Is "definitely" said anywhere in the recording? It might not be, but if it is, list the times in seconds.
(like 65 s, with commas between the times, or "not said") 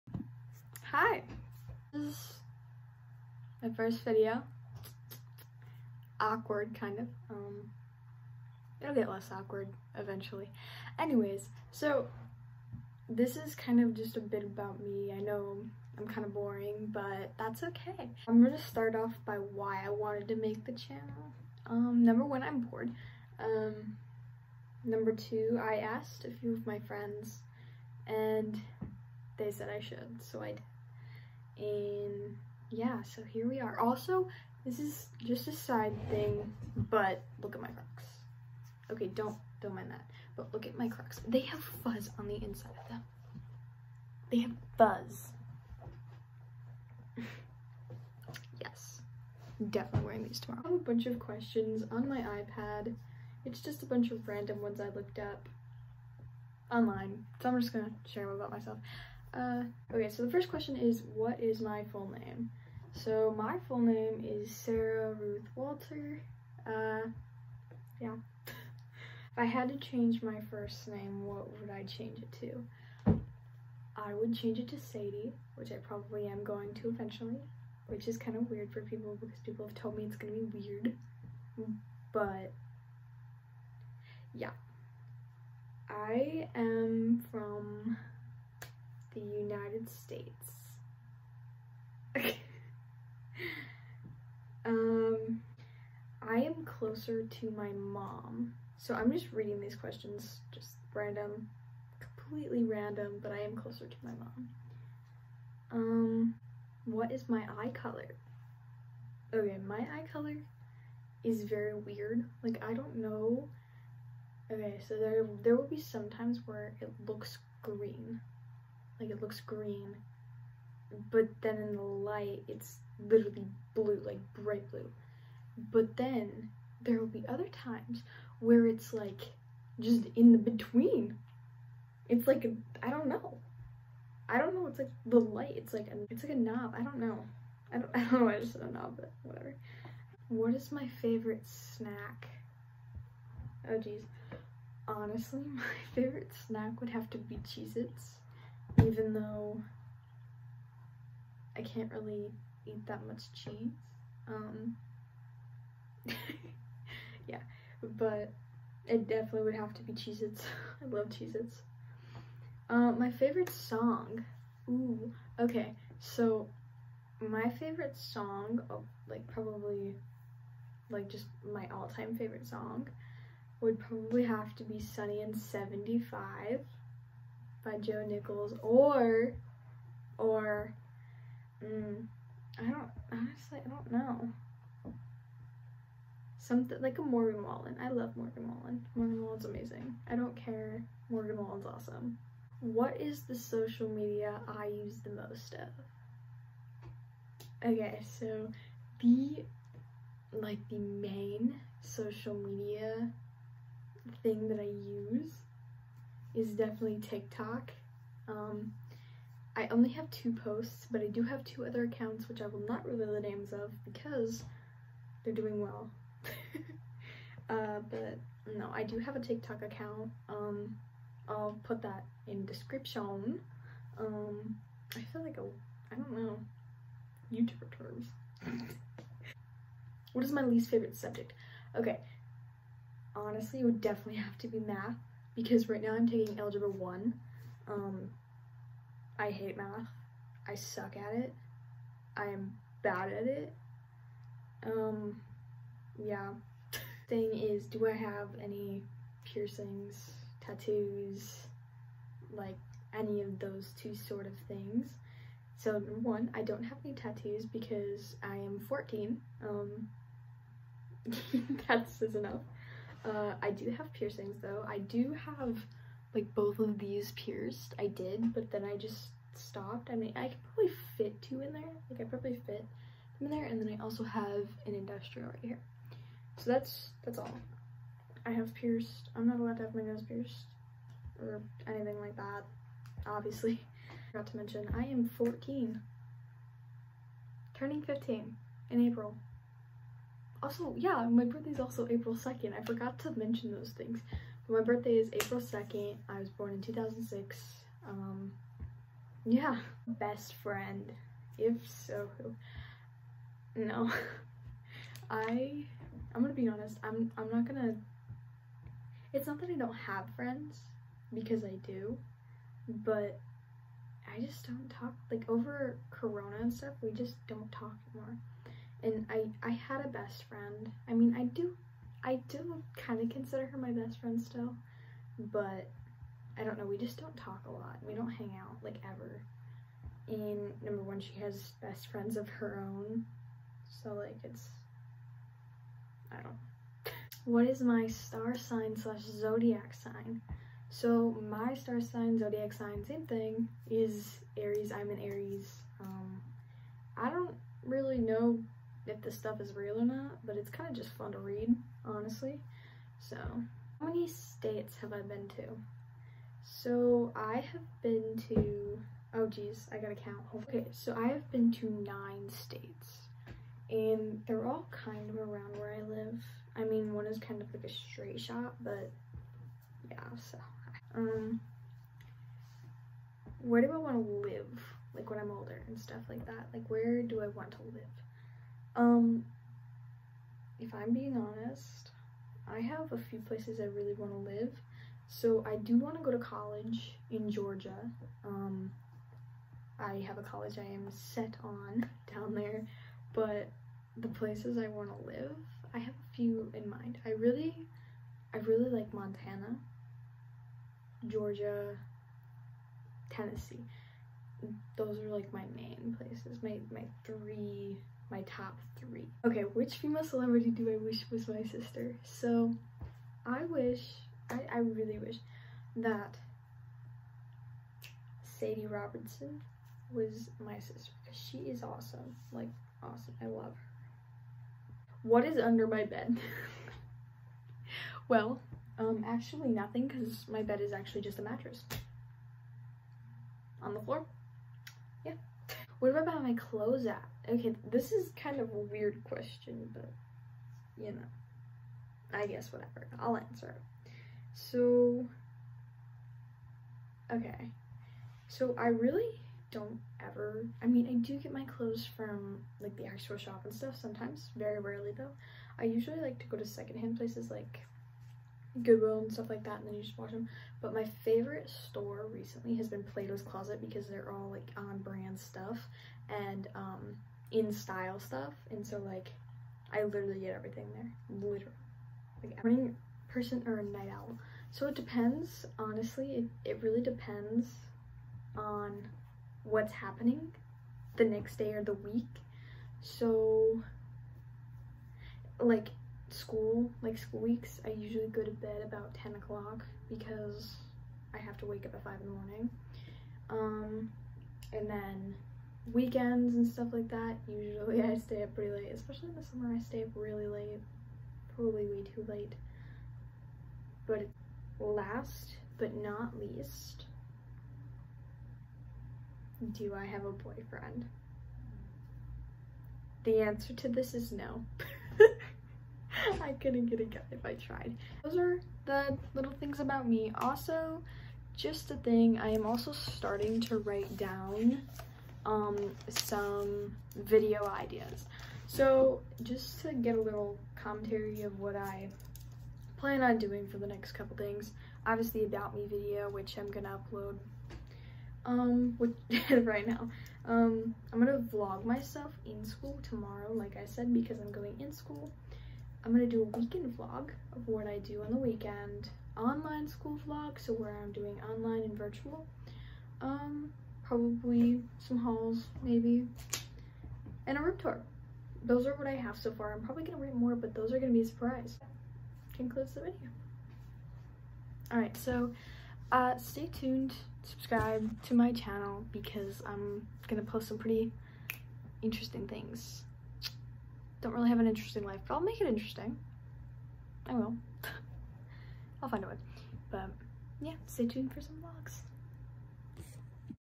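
49 s, 159 s, 206 s, 233 s.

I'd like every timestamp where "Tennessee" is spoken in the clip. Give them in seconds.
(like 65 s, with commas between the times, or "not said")
403 s.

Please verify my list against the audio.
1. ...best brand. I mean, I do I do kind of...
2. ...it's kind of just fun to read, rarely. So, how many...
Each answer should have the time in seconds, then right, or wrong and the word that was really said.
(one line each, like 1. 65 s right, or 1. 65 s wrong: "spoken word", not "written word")
1. 319 s wrong: "friend", not "brand"
2. 350 s wrong: "honestly", not "rarely".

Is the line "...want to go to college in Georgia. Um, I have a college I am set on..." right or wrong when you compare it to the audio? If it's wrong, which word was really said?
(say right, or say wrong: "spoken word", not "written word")
right.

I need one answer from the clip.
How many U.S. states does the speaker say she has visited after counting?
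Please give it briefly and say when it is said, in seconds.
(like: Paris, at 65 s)
9, at 361 s.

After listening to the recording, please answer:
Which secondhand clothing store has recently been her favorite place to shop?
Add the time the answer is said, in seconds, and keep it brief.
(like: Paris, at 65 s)
Plato's Closet, at 462 s.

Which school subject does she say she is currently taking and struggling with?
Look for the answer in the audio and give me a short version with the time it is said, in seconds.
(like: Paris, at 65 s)
Algebra 1, at 236 s.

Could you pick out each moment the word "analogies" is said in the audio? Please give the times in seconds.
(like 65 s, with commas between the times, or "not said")
not said.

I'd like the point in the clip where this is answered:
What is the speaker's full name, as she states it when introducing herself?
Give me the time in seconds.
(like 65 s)
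64 s.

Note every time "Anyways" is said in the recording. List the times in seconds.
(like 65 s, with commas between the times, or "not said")
10 s.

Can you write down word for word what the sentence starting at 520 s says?
Also, just a thing, I am also starting to write down um, some video ideas.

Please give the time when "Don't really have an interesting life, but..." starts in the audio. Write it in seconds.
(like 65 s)
573 s.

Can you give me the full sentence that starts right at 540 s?
Um, I'm gonna vlog myself in school tomorrow, like I said, because I'm going in school.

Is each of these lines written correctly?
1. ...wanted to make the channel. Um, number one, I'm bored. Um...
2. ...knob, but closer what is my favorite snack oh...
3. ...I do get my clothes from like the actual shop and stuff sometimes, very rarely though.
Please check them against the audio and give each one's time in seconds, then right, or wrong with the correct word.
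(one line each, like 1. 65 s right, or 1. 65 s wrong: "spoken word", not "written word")
1. 19 s right
2. 138 s wrong: "whatever", not "closer"
3. 450 s right.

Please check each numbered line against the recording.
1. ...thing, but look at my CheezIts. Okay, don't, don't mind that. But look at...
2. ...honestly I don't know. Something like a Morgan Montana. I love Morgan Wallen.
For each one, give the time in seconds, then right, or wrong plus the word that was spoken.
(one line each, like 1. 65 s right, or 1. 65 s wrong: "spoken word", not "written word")
1. 36 s wrong: "Crocs", not "CheezIts"
2. 183 s wrong: "Wallen", not "Montana".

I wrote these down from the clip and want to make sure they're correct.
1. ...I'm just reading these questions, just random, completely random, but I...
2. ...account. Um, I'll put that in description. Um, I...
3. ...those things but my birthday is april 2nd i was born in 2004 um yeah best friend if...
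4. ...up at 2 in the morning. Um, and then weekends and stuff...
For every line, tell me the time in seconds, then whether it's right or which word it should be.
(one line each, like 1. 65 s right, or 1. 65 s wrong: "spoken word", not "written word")
1. 98 s right
2. 219 s right
3. 293 s wrong: "2006", not "2004"
4. 491 s wrong: "5", not "2".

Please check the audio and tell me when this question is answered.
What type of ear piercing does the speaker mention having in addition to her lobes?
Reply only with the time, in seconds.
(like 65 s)
274 s.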